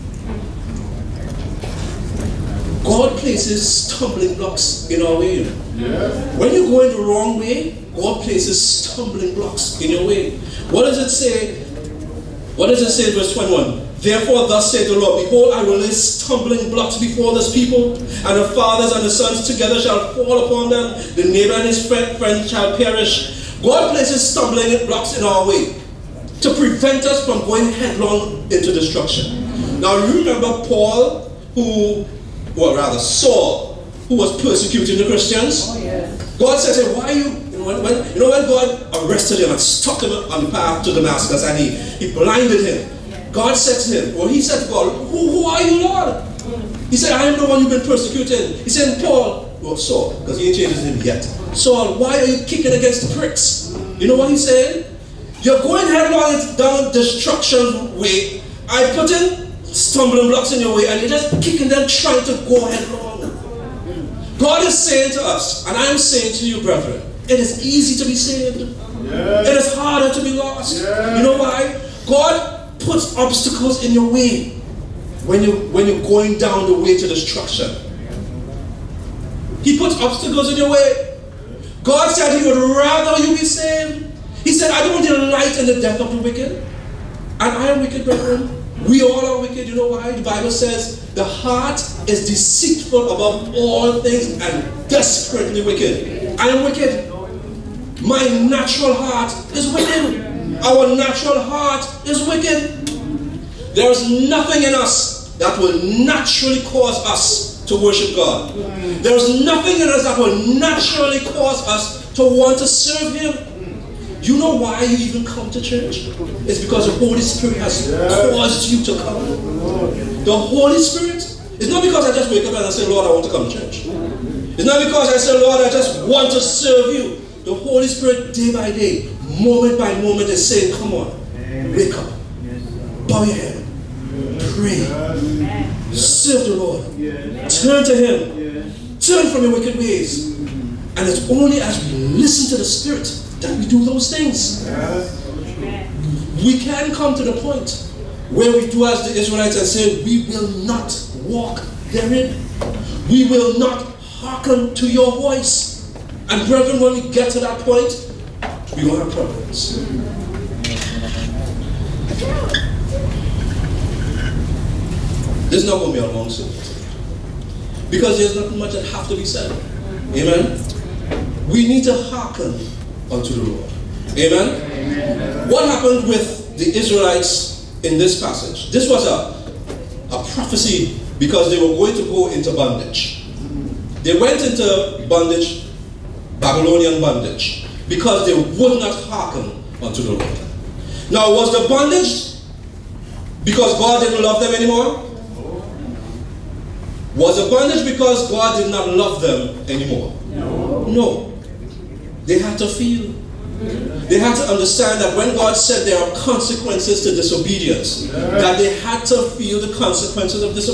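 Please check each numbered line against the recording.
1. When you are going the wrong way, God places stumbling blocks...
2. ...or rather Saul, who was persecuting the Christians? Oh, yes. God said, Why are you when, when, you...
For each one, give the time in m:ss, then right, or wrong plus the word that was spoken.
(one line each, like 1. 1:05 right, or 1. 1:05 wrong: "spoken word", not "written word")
1. 0:05 right
2. 0:32 right.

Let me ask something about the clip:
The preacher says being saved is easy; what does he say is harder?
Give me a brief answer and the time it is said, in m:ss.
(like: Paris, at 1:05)
To be lost, at 1:10.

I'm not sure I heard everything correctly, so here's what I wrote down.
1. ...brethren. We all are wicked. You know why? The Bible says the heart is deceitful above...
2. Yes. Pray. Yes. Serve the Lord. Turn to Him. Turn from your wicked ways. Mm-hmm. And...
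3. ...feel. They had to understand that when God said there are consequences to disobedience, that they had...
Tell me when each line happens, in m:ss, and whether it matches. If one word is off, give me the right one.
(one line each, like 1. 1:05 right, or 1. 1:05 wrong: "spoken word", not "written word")
1. 1:28 right
2. 2:14 right
3. 3:22 right.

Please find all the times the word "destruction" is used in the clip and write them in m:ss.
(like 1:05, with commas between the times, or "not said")
0:28, 0:56, 1:17.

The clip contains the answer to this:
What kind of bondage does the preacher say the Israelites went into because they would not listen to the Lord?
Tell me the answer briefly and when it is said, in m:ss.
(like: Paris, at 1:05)
Babylonian bondage, at 3:06.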